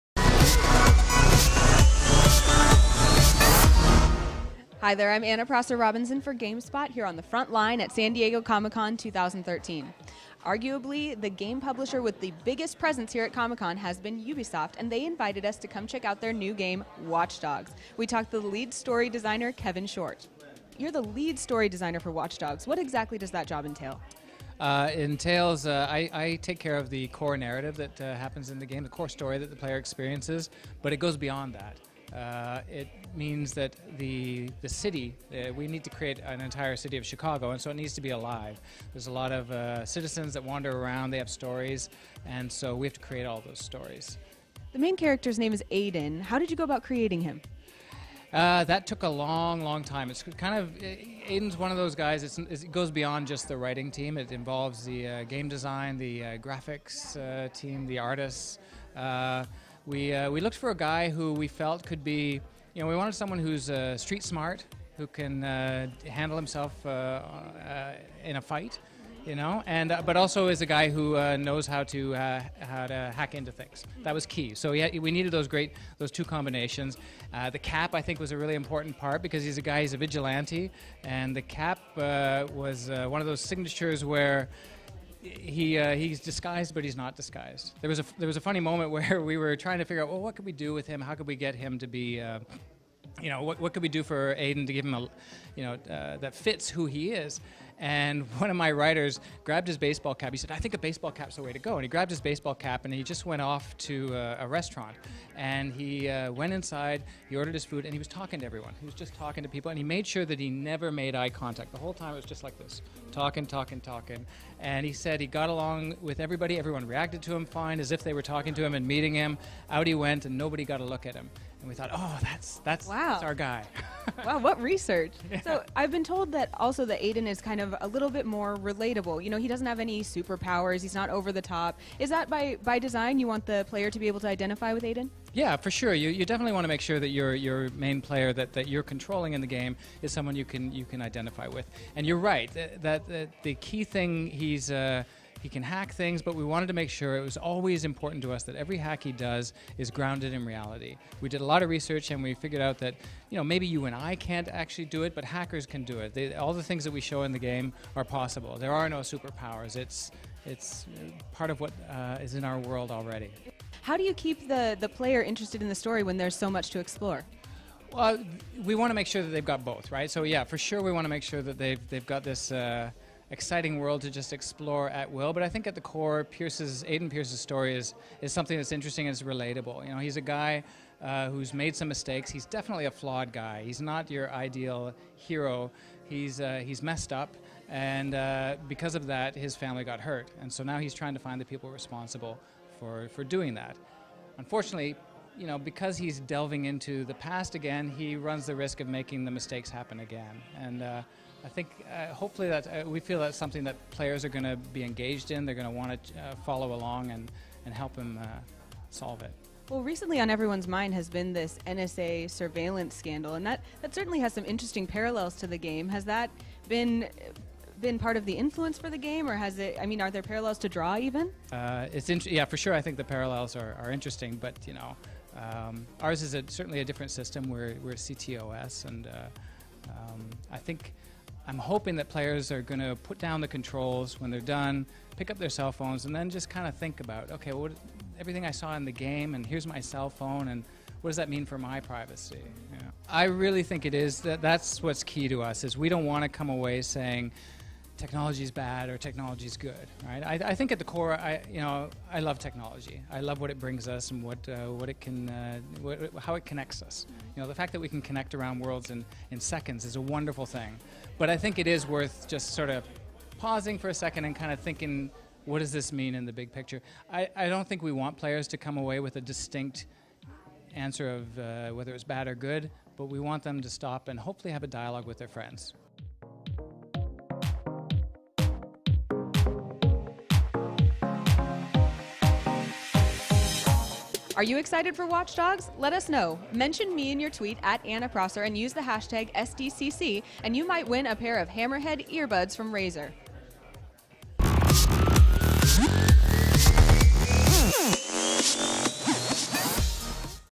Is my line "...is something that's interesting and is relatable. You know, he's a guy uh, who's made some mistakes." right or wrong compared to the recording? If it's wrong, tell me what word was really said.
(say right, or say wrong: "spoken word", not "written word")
right.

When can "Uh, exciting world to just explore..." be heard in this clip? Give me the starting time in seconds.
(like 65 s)
172 s.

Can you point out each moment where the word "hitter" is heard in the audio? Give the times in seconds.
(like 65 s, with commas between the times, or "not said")
not said.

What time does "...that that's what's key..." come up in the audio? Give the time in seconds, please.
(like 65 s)
244 s.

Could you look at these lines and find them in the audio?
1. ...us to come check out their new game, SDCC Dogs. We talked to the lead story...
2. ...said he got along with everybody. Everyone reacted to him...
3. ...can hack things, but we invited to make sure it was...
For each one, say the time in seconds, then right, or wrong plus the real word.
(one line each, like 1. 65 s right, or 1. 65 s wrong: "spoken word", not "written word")
1. 15 s wrong: "Watch", not "SDCC"
2. 114 s right
3. 145 s wrong: "wanted", not "invited".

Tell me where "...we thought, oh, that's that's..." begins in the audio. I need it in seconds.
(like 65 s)
121 s.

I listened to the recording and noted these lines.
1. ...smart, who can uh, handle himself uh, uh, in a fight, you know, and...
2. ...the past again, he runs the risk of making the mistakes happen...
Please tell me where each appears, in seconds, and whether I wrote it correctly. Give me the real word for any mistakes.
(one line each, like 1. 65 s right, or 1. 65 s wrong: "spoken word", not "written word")
1. 64 s right
2. 197 s right.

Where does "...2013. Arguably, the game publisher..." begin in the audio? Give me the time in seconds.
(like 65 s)
8 s.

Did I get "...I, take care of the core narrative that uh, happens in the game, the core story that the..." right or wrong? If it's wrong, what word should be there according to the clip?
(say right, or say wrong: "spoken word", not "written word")
right.